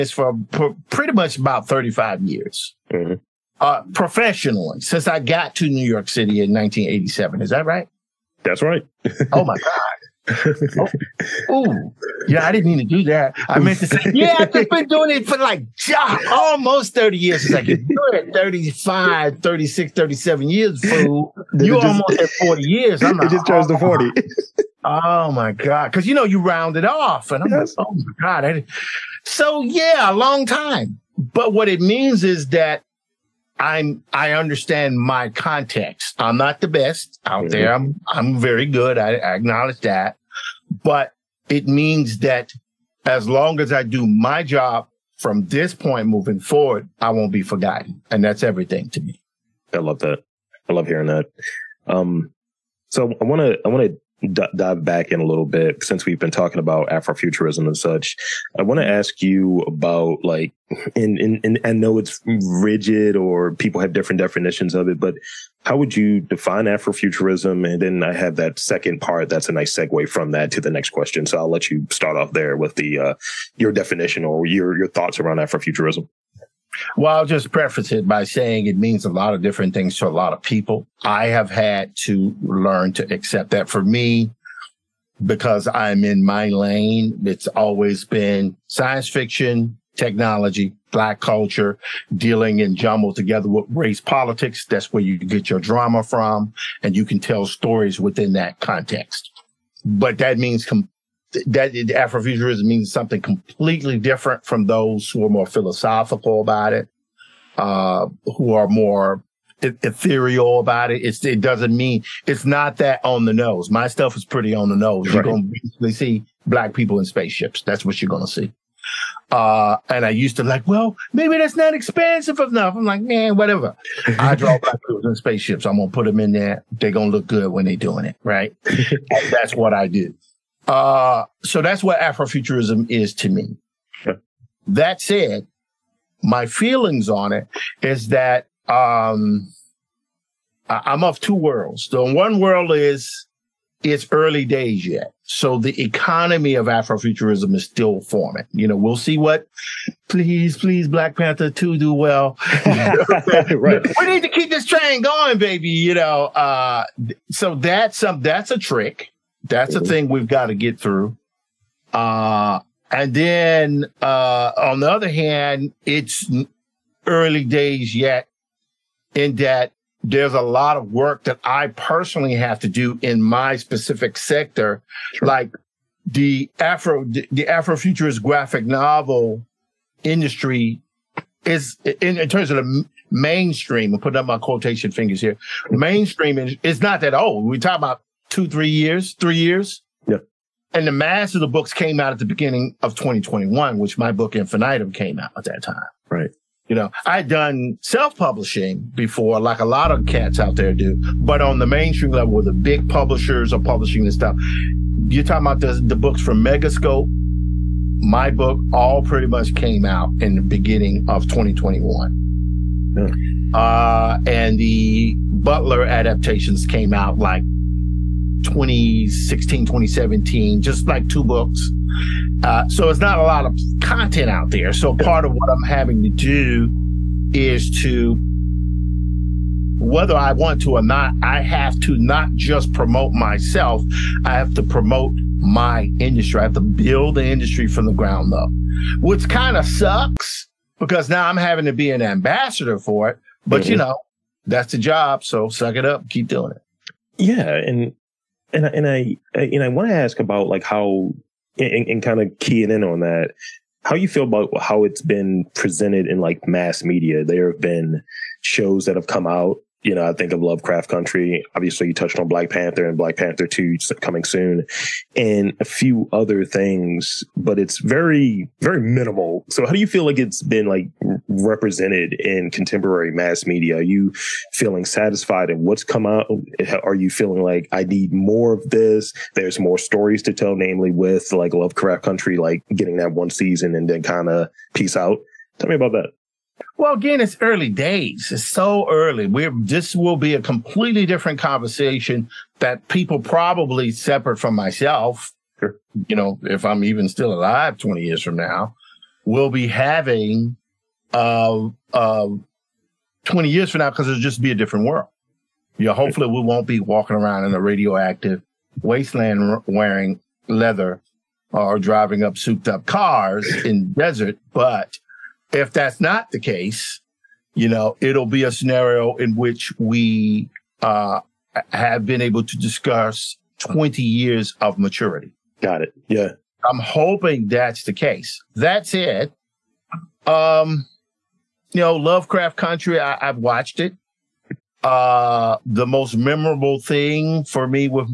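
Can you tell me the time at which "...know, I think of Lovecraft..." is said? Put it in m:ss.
4:19.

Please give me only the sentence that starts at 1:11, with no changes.
So I'll let you start off there with the, uh, your definition or your, your thoughts around Afrofuturism.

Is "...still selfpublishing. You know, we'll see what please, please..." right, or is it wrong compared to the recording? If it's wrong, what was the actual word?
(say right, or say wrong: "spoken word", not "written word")
wrong: "forming", not "selfpublishing".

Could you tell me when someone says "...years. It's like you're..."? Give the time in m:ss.
0:17.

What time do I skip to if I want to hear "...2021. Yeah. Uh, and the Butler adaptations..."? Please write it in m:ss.
3:31.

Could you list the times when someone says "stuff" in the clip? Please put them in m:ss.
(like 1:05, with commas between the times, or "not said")
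1:53, 3:24.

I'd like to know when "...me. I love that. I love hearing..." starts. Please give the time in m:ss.
0:48.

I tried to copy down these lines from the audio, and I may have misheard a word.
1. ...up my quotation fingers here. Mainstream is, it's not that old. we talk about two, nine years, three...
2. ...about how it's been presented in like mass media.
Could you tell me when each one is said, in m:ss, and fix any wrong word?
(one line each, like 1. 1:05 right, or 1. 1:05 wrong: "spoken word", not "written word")
1. 3:04 wrong: "three", not "nine"
2. 4:14 right.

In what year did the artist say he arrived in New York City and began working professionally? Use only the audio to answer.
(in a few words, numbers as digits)
1987.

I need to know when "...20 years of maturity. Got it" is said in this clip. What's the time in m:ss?
5:23.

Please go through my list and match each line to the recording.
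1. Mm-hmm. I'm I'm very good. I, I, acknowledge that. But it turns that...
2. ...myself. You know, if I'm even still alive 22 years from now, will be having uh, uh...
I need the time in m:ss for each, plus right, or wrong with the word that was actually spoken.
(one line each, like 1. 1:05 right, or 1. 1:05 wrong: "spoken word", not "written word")
1. 0:37 wrong: "means", not "turns"
2. 4:54 wrong: "20", not "22".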